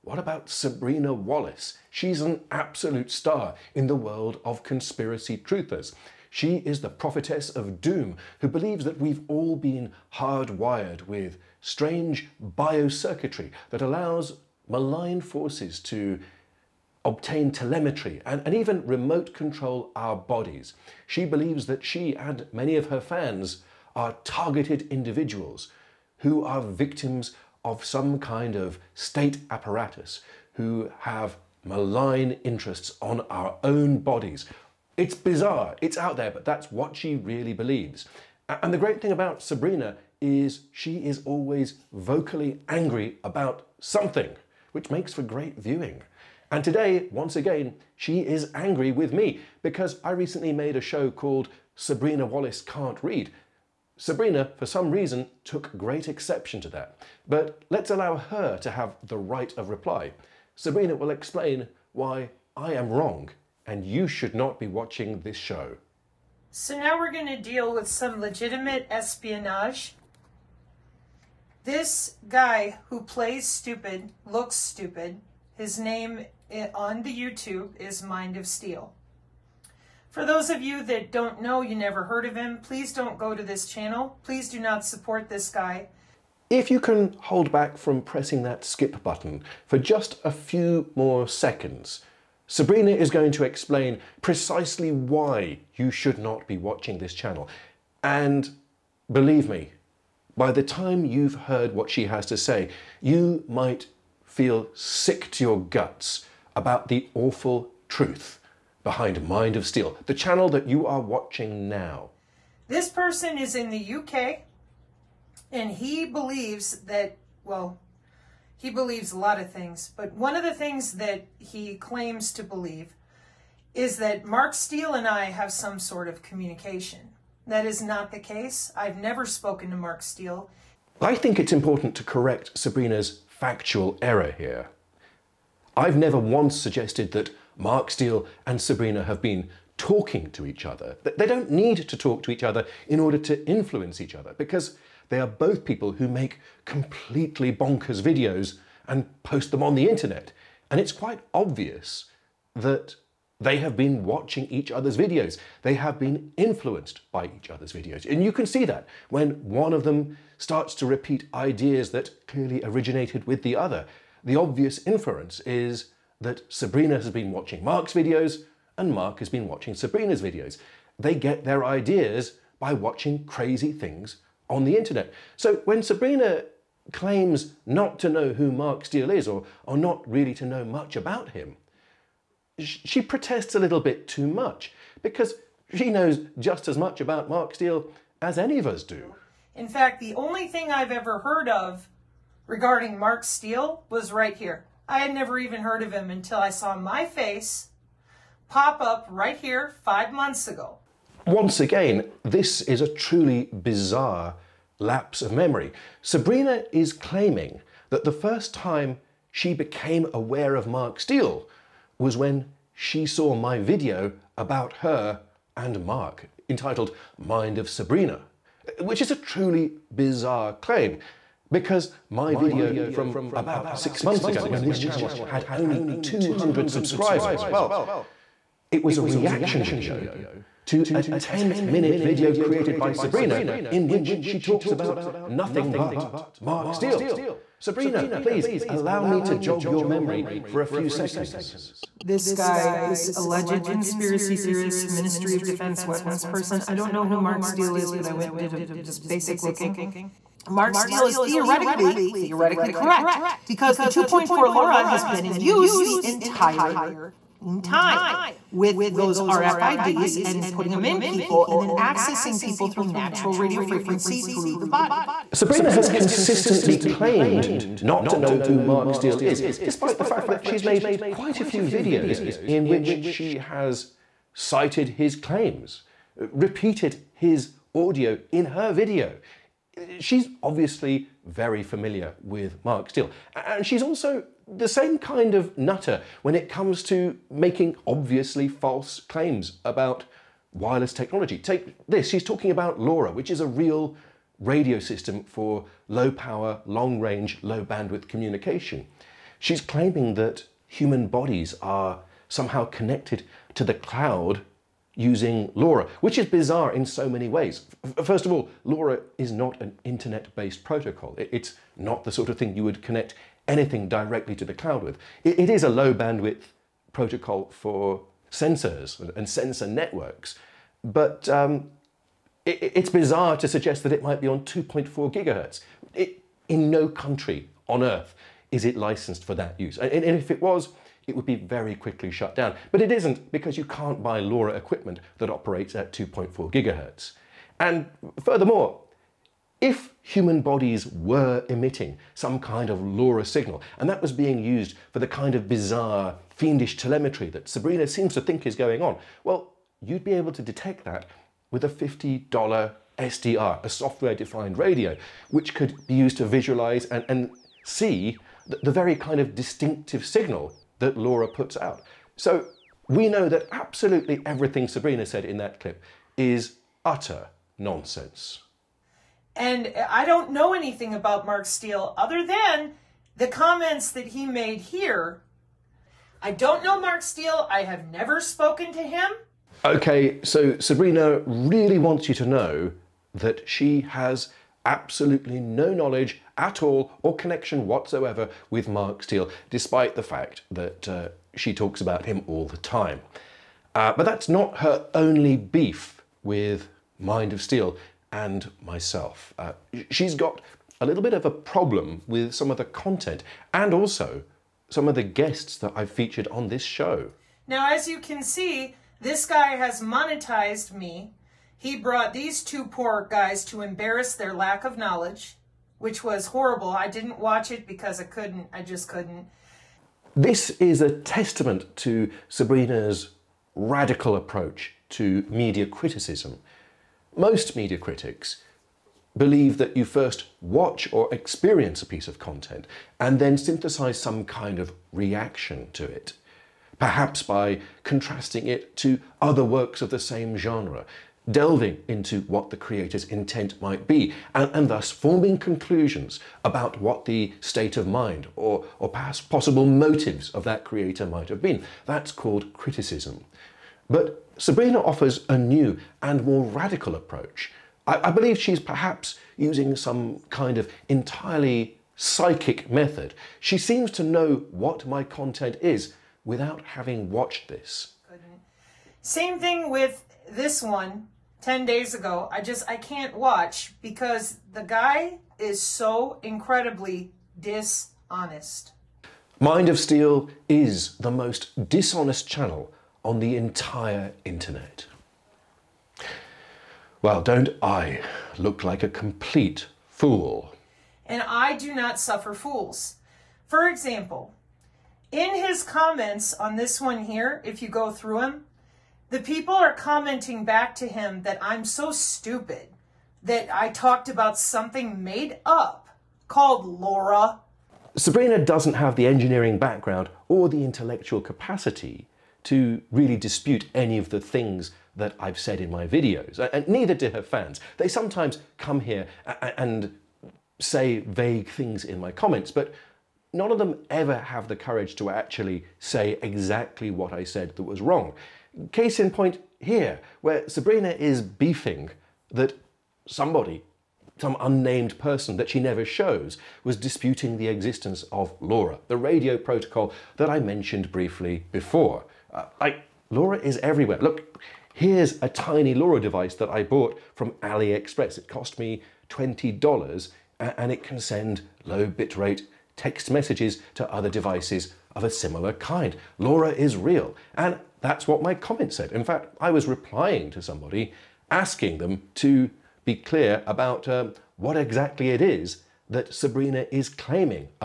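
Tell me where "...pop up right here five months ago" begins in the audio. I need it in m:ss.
3:18.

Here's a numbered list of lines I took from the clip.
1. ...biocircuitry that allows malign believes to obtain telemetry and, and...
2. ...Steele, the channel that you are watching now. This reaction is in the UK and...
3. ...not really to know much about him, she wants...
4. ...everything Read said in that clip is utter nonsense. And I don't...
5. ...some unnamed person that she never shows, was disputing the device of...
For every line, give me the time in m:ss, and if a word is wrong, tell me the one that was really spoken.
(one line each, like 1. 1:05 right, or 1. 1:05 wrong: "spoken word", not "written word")
1. 0:12 wrong: "forces", not "believes"
2. 1:49 wrong: "person", not "reaction"
3. 2:59 wrong: "protests", not "wants"
4. 6:04 wrong: "Sabrina", not "Read"
5. 8:54 wrong: "existence", not "device".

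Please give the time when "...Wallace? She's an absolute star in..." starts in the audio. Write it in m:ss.
0:01.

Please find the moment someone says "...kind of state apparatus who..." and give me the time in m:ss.
0:28.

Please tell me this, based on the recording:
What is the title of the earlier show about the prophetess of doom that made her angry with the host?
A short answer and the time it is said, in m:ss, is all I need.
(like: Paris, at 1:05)
Sabrina Wallace Can't Read, at 0:51.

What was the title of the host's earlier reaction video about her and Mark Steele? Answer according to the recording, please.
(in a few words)
Mind of Sabrina.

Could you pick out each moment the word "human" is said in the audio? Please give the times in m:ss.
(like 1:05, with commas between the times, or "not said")
5:00, 5:40.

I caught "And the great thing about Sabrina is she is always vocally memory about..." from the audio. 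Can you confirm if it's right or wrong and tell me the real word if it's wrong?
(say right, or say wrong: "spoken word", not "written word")
wrong: "angry", not "memory".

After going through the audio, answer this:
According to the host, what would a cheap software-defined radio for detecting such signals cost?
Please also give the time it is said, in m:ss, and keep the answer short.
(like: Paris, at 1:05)
$50, at 5:51.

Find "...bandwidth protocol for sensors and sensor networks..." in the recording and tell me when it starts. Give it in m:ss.
5:15.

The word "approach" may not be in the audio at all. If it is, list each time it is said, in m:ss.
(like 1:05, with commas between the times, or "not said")
7:04, 7:36.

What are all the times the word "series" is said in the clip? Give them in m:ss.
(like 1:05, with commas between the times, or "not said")
not said.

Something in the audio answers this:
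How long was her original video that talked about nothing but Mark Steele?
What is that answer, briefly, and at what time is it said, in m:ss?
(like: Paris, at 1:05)
10 minute, at 3:51.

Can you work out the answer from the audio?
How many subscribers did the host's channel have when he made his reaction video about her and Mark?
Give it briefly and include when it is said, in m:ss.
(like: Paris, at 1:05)
200, at 3:46.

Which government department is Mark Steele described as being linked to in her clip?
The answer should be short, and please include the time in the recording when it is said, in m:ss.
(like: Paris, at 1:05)
Ministry of Defense, at 4:04.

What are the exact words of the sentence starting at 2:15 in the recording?
I've never once suggested that Mark Steele and Sabrina have been talking to each other.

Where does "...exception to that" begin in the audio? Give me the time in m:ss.
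0:56.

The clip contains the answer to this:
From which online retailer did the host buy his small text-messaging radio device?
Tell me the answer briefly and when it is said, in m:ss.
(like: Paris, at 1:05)
AliExpress, at 9:07.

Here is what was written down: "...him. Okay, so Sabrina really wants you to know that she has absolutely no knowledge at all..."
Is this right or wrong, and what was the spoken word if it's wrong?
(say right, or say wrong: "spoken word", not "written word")
right.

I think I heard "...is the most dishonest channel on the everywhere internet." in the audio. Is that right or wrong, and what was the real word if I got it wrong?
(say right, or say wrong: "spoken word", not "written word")
wrong: "entire", not "everywhere".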